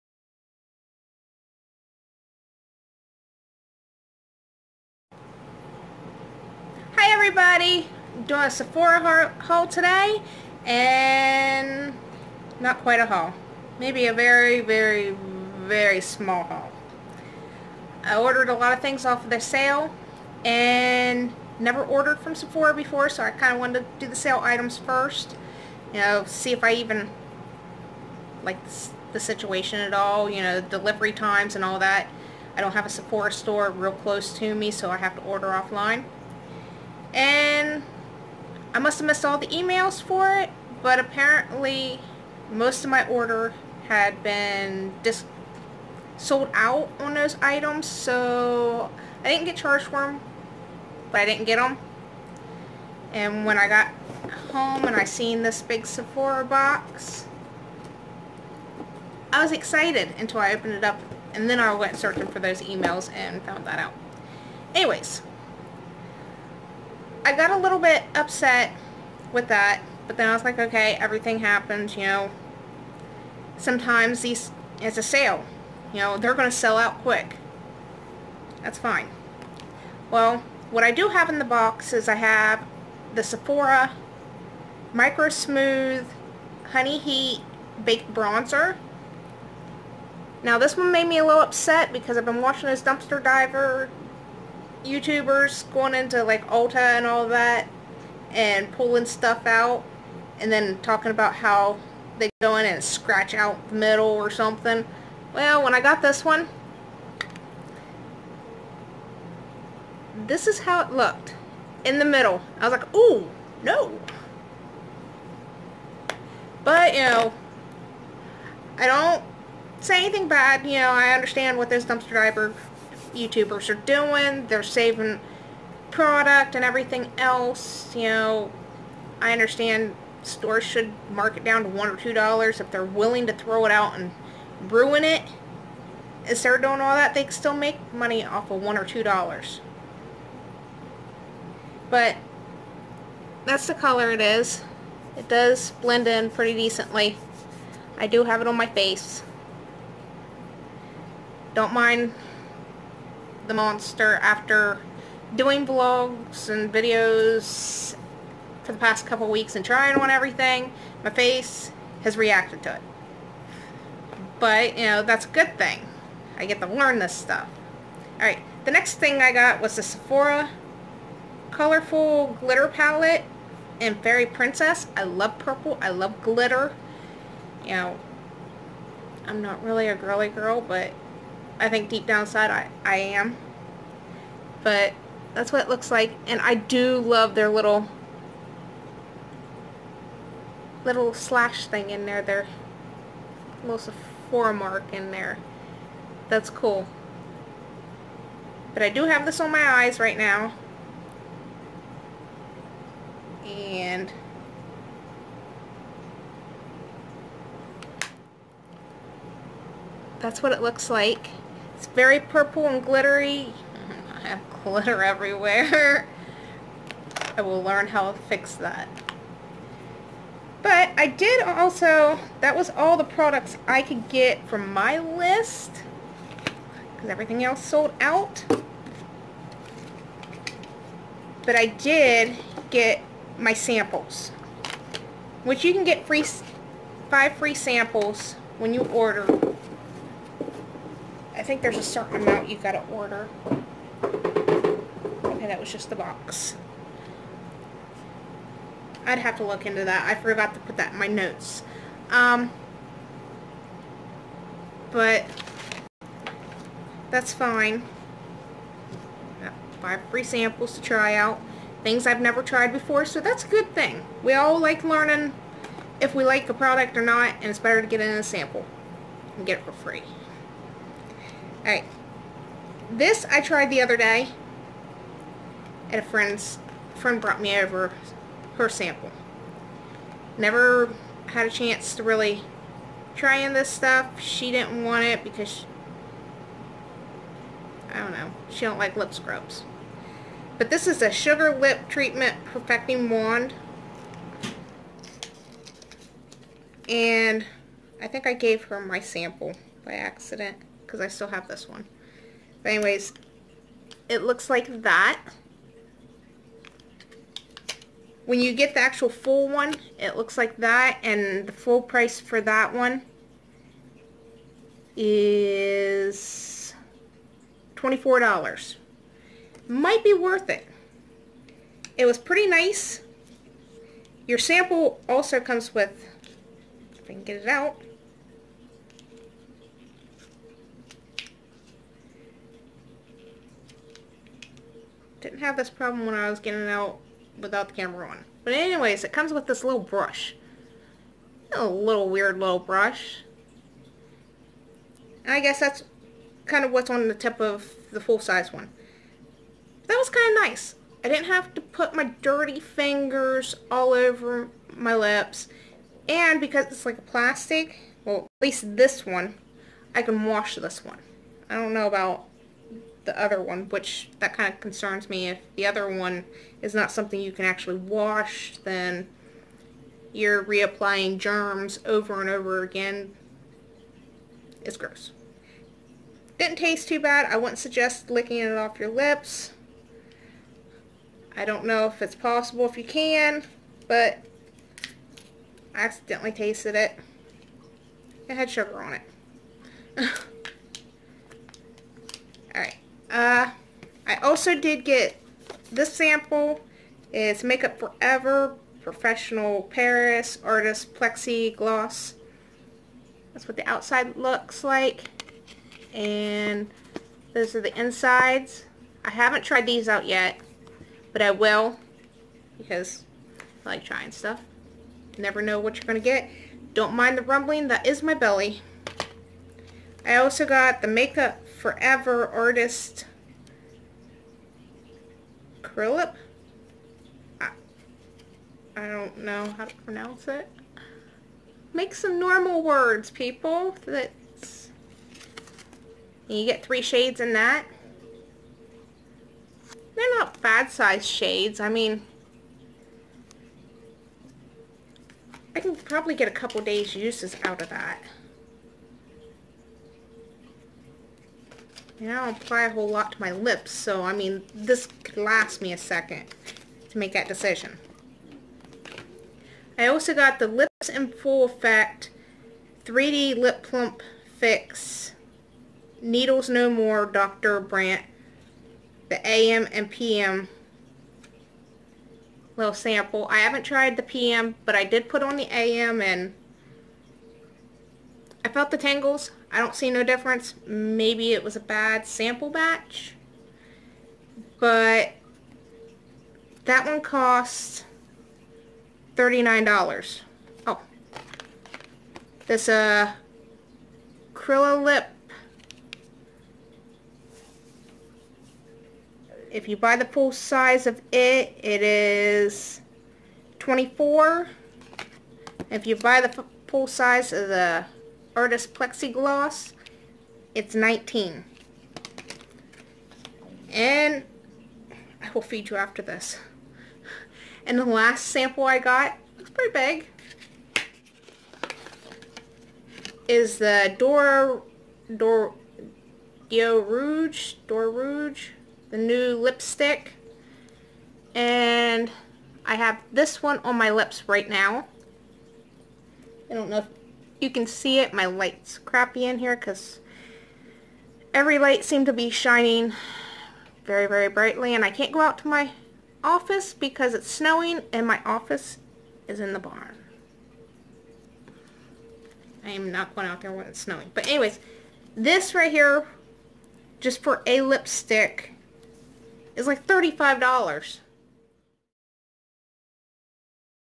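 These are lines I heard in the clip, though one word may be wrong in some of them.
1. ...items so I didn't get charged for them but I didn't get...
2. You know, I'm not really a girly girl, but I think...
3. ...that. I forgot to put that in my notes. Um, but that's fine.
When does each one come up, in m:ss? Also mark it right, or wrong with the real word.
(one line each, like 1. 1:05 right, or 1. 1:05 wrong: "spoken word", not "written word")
1. 0:47 right
2. 2:57 right
3. 4:09 right.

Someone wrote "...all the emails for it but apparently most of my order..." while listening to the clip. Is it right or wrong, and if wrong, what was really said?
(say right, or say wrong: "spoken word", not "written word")
right.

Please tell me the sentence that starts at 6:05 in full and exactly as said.
If the other one is not something you can actually wash, then you're reapplying germs over and over again.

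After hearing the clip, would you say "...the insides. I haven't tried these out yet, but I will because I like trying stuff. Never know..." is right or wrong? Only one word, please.
right.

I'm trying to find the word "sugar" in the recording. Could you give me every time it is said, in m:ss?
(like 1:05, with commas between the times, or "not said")
4:51, 6:28.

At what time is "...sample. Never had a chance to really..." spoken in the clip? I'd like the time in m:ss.
4:38.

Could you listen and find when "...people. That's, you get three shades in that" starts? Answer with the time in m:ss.
7:13.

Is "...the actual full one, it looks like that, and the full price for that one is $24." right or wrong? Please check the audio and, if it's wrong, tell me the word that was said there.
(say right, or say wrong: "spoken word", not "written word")
right.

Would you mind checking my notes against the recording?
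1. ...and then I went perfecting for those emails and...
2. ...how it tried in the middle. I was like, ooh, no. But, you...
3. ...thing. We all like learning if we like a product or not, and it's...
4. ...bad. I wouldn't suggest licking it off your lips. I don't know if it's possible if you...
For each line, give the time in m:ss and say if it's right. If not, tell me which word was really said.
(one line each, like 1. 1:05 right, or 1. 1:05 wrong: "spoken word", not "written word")
1. 1:01 wrong: "searching", not "perfecting"
2. 1:50 wrong: "looked", not "tried"
3. 4:23 right
4. 6:16 right.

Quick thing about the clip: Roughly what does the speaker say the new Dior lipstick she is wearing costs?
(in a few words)
$35.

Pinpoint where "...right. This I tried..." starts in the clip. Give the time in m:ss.
4:31.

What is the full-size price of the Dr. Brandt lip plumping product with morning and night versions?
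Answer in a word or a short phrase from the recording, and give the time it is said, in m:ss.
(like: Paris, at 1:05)
$39, at 8:09.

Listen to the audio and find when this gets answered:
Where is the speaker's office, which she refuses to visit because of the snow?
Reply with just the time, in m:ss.
9:09.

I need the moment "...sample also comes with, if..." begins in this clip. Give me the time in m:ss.
5:24.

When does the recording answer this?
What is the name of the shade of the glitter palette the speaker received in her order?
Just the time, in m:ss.
2:53.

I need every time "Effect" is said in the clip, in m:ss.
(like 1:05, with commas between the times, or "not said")
7:41.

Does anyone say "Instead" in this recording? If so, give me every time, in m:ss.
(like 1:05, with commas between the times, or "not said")
2:16.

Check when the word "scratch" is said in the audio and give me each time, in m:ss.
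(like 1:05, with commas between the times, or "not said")
1:42.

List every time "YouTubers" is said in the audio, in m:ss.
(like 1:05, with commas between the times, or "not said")
1:34, 2:03.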